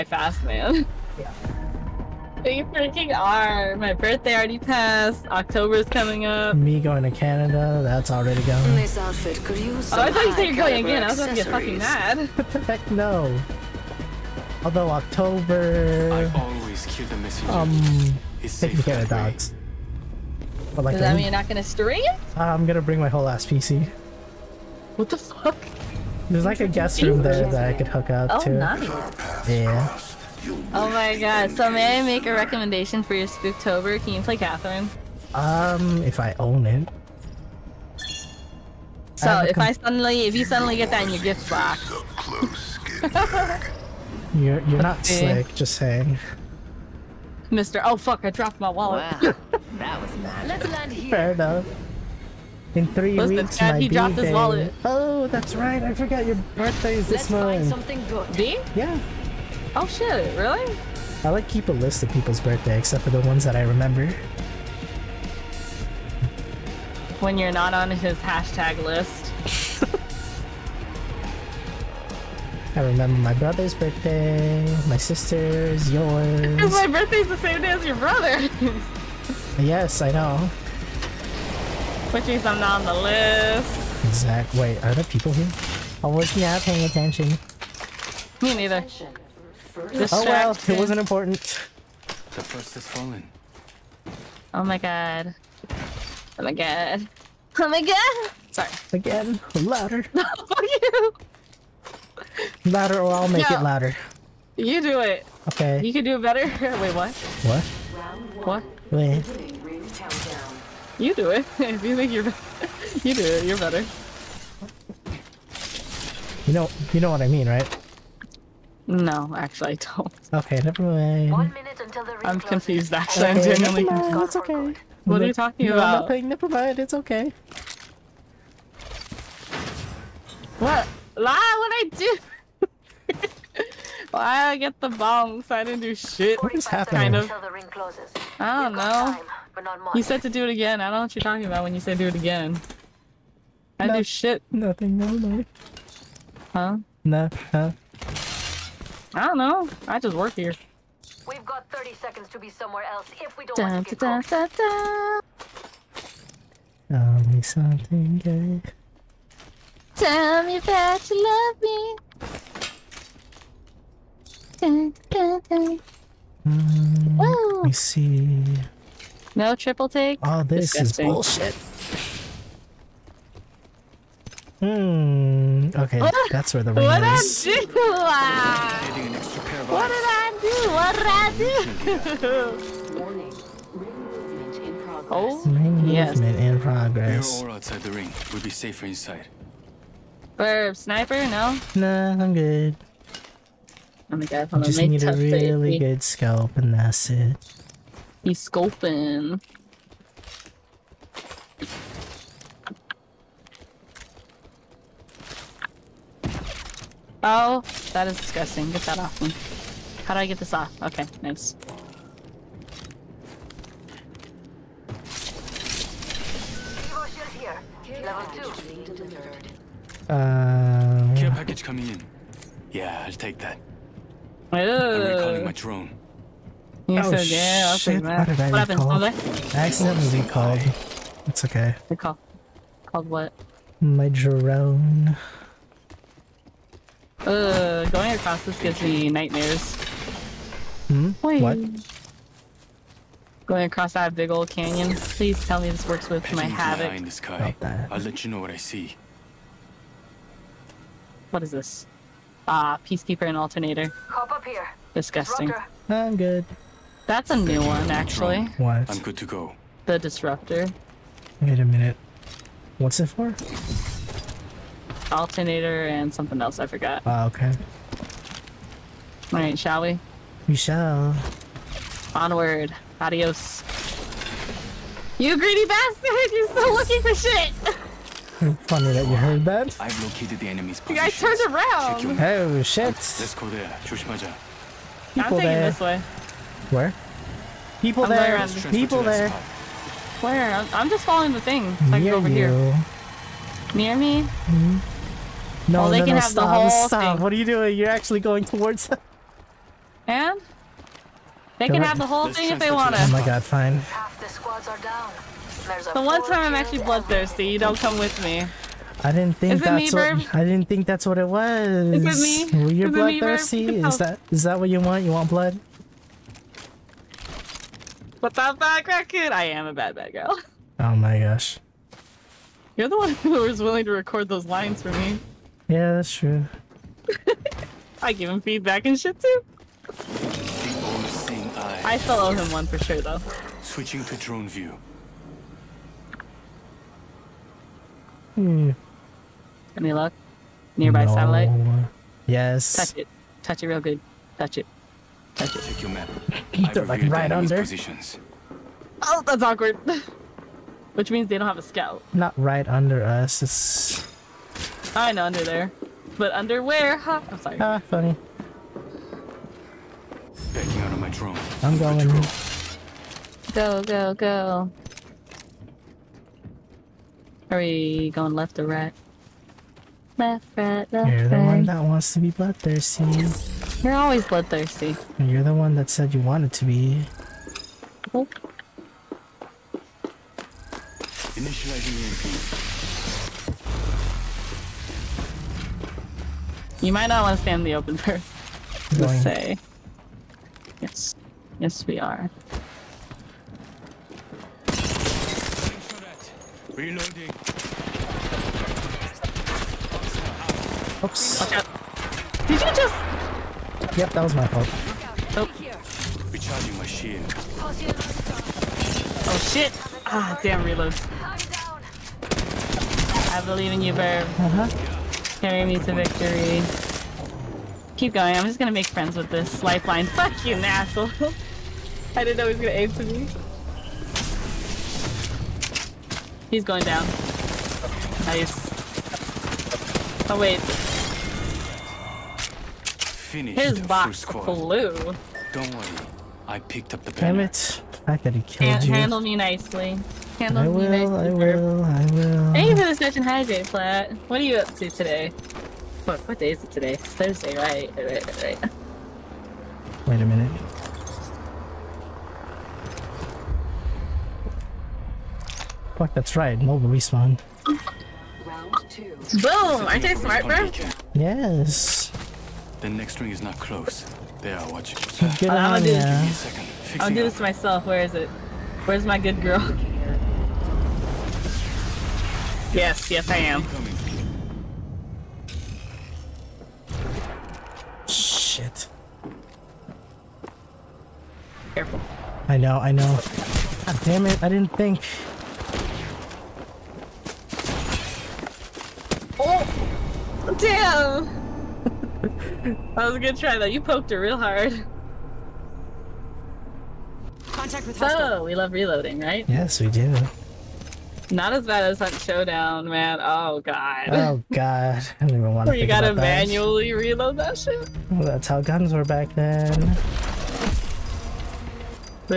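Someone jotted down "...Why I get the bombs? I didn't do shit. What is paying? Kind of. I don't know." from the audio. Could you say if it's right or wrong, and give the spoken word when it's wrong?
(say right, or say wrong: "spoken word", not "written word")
wrong: "happening", not "paying".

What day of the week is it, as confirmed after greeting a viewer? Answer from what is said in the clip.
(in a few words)
Thursday.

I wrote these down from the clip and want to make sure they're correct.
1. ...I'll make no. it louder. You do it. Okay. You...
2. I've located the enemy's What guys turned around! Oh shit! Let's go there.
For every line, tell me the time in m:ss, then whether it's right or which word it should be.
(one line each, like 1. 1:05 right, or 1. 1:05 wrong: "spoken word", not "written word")
1. 1:43 right
2. 4:39 wrong: "You", not "What".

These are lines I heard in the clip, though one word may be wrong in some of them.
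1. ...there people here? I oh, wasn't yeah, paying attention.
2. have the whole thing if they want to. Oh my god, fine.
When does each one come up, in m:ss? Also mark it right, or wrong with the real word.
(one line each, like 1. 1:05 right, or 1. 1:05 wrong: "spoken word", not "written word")
1. 1:24 right
2. 5:01 right.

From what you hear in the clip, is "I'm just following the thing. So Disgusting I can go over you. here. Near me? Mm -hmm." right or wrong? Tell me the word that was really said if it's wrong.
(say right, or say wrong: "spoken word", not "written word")
wrong: "Near", not "Disgusting".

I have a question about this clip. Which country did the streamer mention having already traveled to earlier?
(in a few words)
Canada.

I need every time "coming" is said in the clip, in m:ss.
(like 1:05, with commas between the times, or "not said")
0:05, 3:41.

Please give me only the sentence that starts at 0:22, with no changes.
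I'm gonna bring my whole ass PC.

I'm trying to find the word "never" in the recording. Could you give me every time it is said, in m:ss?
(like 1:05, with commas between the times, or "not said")
2:00, 2:06, 2:24.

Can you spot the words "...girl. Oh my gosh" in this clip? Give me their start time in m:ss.
5:20.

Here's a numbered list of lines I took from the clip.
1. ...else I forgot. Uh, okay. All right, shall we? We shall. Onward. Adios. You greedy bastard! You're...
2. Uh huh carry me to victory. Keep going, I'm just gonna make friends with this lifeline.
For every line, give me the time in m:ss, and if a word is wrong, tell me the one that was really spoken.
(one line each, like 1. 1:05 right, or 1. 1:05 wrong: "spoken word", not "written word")
1. 4:26 right
2. 6:54 right.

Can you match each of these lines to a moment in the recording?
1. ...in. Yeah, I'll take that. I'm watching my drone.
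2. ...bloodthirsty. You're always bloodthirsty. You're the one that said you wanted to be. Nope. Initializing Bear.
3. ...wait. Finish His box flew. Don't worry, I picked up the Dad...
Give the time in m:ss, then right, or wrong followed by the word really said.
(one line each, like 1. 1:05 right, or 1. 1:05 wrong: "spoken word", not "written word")
1. 3:41 wrong: "recalling", not "watching"
2. 6:12 wrong: "EMP", not "Bear"
3. 7:10 wrong: "Damn", not "Dad".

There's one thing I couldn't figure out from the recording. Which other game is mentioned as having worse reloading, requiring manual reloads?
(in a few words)
Hunt Showdown.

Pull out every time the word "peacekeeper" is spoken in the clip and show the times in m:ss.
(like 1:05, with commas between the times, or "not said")
4:12.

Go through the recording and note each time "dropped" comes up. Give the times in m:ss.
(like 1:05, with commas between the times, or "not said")
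0:48, 0:53.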